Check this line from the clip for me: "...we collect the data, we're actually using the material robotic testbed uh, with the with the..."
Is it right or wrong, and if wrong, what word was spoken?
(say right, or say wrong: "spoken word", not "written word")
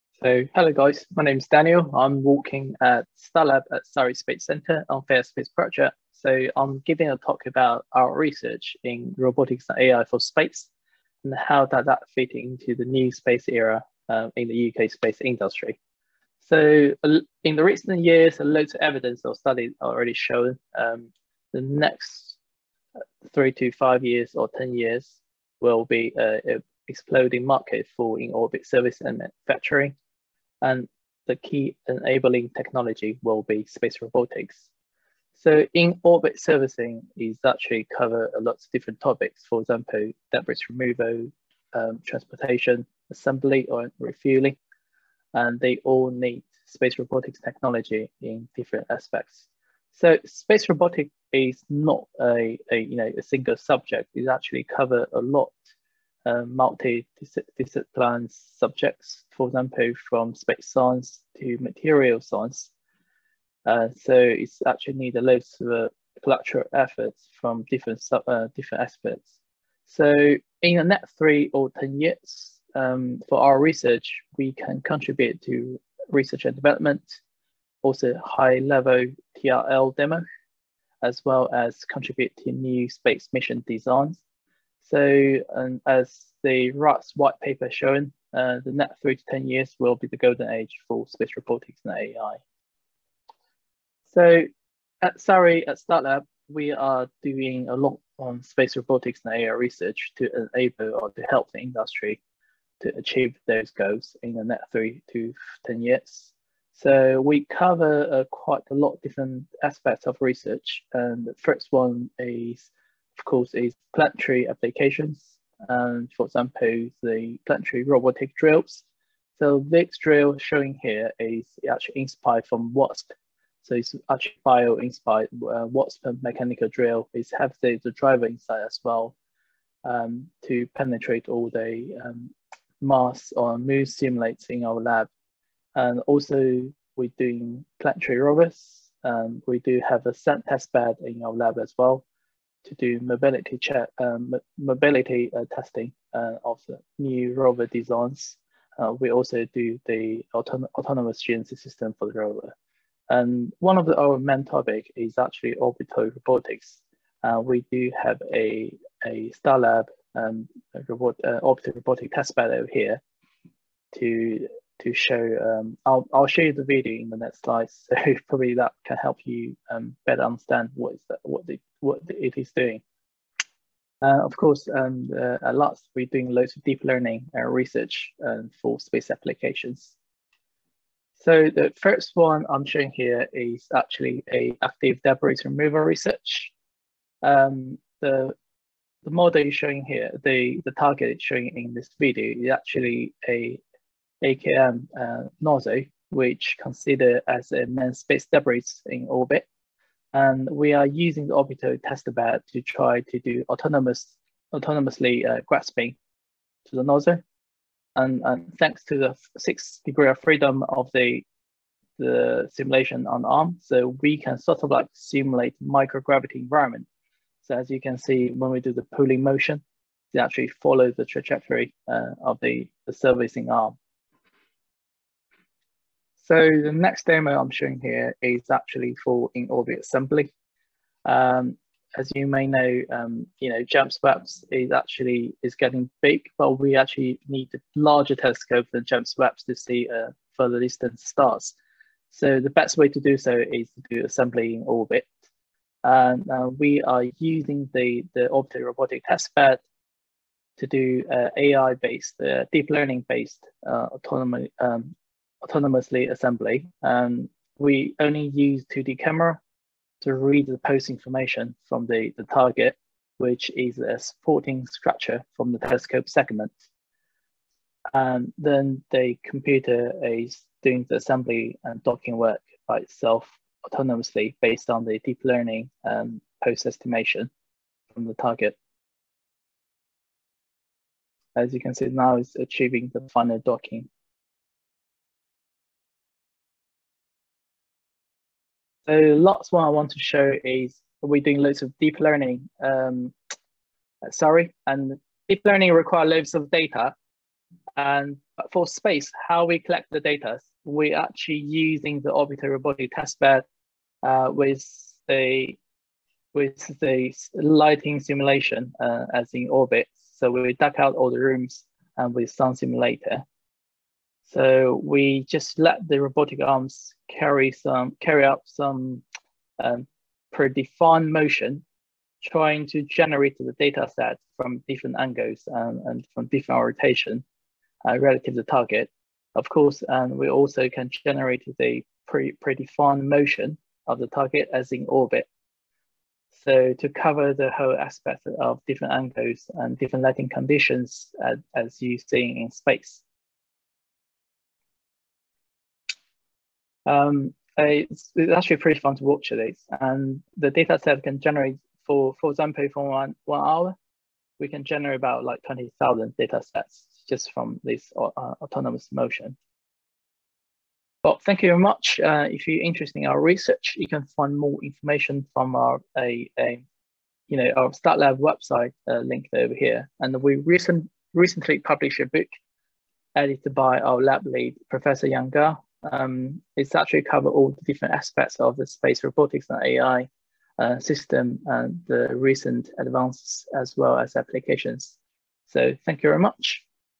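wrong: "orbital", not "material".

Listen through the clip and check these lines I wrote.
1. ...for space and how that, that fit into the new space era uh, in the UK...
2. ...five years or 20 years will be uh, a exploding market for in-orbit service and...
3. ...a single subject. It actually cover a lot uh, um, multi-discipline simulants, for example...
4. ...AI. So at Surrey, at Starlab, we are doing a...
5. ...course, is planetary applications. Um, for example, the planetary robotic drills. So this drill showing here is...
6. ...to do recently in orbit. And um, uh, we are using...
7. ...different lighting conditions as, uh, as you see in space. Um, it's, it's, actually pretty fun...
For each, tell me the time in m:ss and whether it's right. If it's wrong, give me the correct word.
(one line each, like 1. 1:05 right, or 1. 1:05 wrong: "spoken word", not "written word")
1. 0:10 right
2. 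0:23 wrong: "10", not "20"
3. 0:53 wrong: "subjects", not "simulants"
4. 1:31 right
5. 1:53 right
6. 4:03 wrong: "assembly", not "recently"
7. 5:39 right.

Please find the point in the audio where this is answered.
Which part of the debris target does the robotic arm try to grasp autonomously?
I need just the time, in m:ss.
3:26.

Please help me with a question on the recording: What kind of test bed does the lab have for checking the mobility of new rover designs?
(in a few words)
Sand test bed.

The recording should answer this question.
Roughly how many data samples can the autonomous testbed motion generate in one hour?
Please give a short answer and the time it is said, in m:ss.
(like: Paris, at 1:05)
20,000, at 5:55.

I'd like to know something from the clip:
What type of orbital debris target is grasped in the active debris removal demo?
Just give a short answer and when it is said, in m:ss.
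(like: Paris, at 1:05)
AKM, at 3:14.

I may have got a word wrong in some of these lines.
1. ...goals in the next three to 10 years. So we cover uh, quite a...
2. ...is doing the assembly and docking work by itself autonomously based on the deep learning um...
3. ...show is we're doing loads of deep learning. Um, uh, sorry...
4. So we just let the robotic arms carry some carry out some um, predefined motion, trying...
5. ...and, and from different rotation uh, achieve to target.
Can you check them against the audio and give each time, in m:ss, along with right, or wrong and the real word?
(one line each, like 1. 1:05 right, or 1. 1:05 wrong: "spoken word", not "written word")
1. 1:43 right
2. 4:30 right
3. 4:49 right
4. 5:14 right
5. 5:25 wrong: "relative", not "achieve".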